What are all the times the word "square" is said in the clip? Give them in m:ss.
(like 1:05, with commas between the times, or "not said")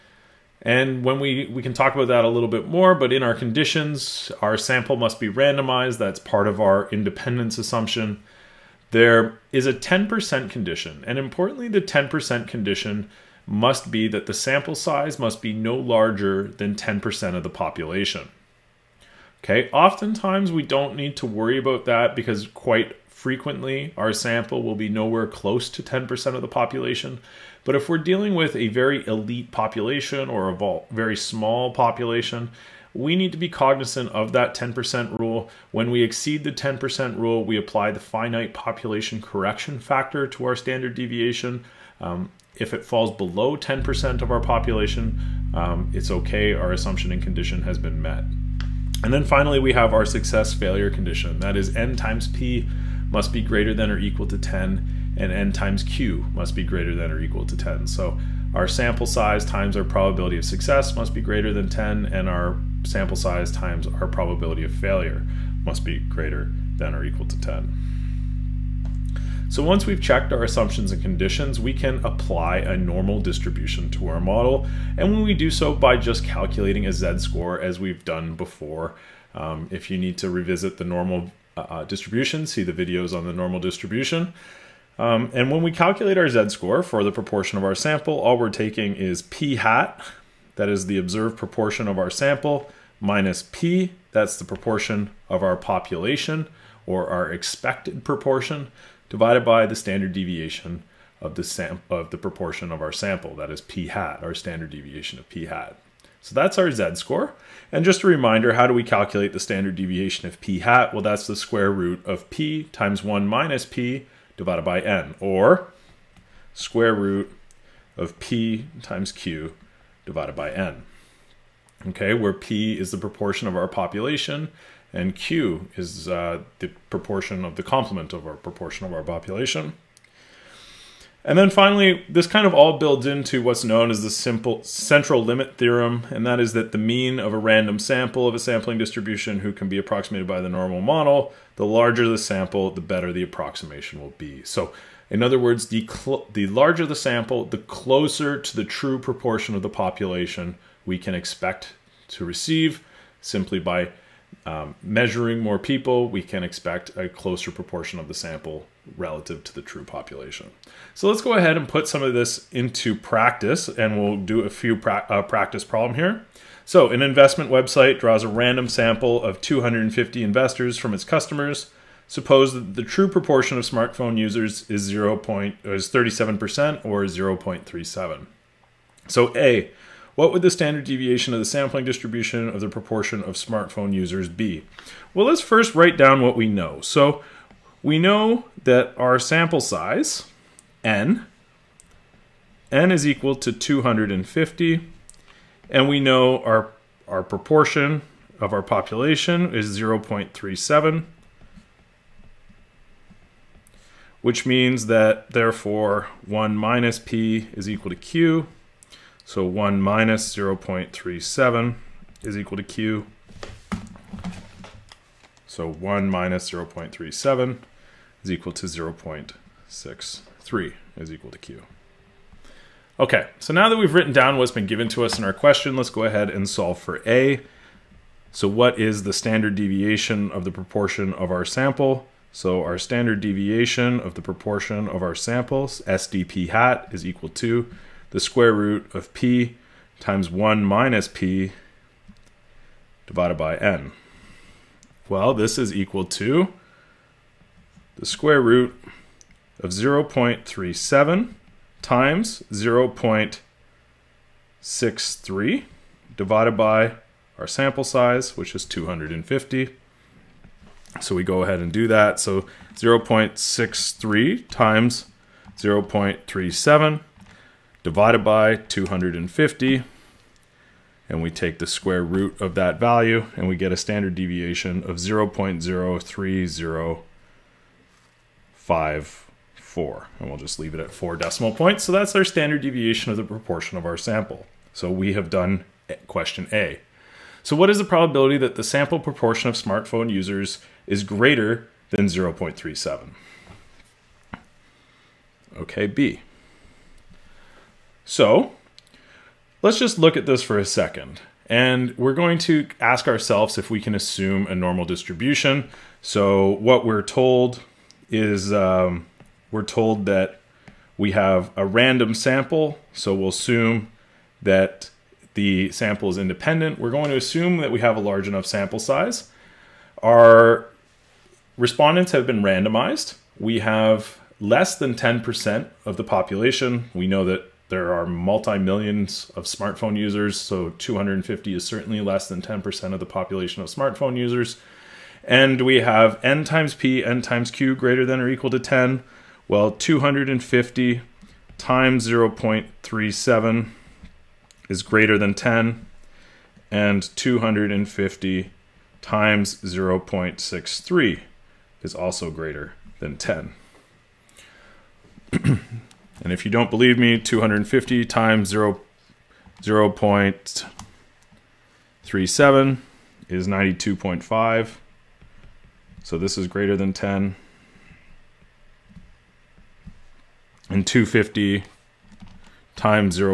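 1:51, 1:56, 3:58, 4:08, 4:31.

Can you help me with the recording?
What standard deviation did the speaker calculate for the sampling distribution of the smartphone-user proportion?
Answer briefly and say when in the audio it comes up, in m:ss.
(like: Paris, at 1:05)
0.03054, at 4:34.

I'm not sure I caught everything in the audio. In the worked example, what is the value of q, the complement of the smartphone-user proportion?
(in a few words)
0.63.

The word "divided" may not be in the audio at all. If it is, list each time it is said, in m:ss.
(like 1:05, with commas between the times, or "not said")
1:39, 1:54, 2:00, 4:03, 4:16, 4:27.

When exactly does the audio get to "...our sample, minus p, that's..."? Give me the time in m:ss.
1:31.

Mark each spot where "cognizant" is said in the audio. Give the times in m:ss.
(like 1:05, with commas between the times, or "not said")
0:33.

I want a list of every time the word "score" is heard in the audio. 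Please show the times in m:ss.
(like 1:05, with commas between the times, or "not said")
1:16, 1:26, 1:46.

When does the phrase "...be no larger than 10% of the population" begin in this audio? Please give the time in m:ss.
0:15.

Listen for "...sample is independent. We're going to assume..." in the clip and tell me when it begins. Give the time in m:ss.
5:15.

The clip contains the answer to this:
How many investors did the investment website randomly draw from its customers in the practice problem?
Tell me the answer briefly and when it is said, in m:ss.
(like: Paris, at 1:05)
250, at 2:49.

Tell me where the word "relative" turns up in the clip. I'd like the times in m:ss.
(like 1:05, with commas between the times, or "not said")
2:38.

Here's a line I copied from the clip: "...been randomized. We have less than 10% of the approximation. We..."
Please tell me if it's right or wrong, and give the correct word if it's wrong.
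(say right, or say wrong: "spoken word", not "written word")
wrong: "population", not "approximation".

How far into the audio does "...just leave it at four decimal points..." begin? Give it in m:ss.
4:40.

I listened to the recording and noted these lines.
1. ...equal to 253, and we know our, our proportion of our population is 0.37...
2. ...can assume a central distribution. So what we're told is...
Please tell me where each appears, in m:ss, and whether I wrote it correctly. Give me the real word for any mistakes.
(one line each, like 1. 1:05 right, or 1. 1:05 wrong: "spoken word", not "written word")
1. 3:13 wrong: "250", not "253"
2. 5:03 wrong: "normal", not "central".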